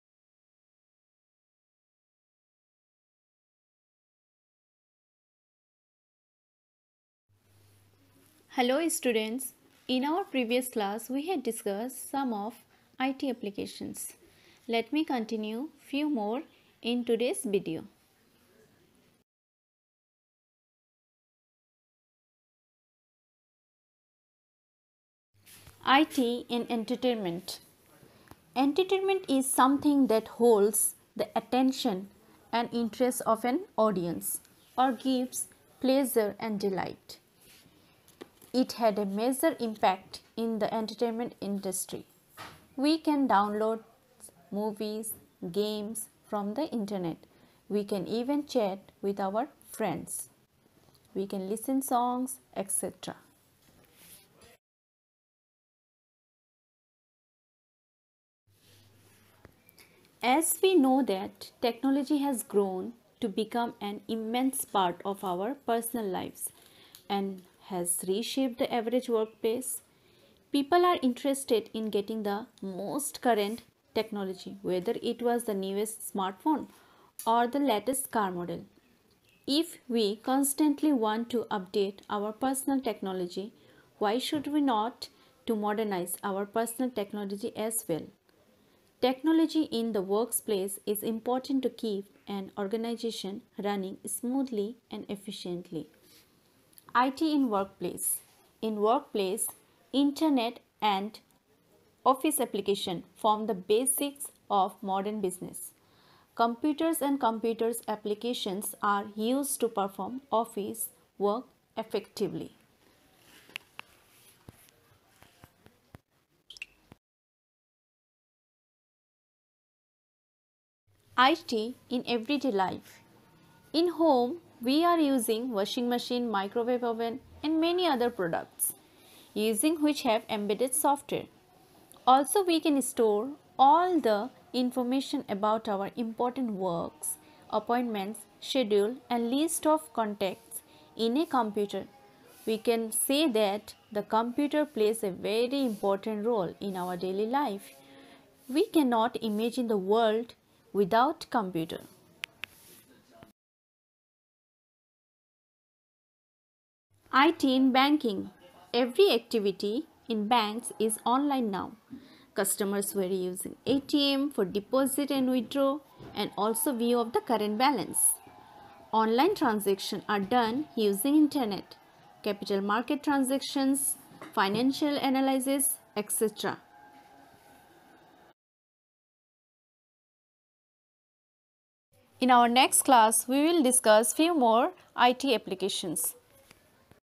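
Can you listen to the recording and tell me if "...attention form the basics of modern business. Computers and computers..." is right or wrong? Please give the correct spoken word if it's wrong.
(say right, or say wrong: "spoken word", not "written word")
wrong: "application", not "attention".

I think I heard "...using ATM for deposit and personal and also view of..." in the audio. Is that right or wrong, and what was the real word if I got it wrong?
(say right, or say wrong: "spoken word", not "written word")
wrong: "withdrawal", not "personal".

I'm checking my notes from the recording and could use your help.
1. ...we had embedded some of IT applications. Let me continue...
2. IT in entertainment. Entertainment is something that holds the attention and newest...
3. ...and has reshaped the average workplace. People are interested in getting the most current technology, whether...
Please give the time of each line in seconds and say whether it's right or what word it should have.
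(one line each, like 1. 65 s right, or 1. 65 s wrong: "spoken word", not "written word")
1. 11 s wrong: "discussed", not "embedded"
2. 25 s wrong: "interest", not "newest"
3. 67 s right.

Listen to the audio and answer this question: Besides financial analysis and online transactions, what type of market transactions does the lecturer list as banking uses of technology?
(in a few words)
capital market.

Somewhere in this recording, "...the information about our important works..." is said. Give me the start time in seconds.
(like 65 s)
133 s.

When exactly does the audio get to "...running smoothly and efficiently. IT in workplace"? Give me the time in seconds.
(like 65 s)
93 s.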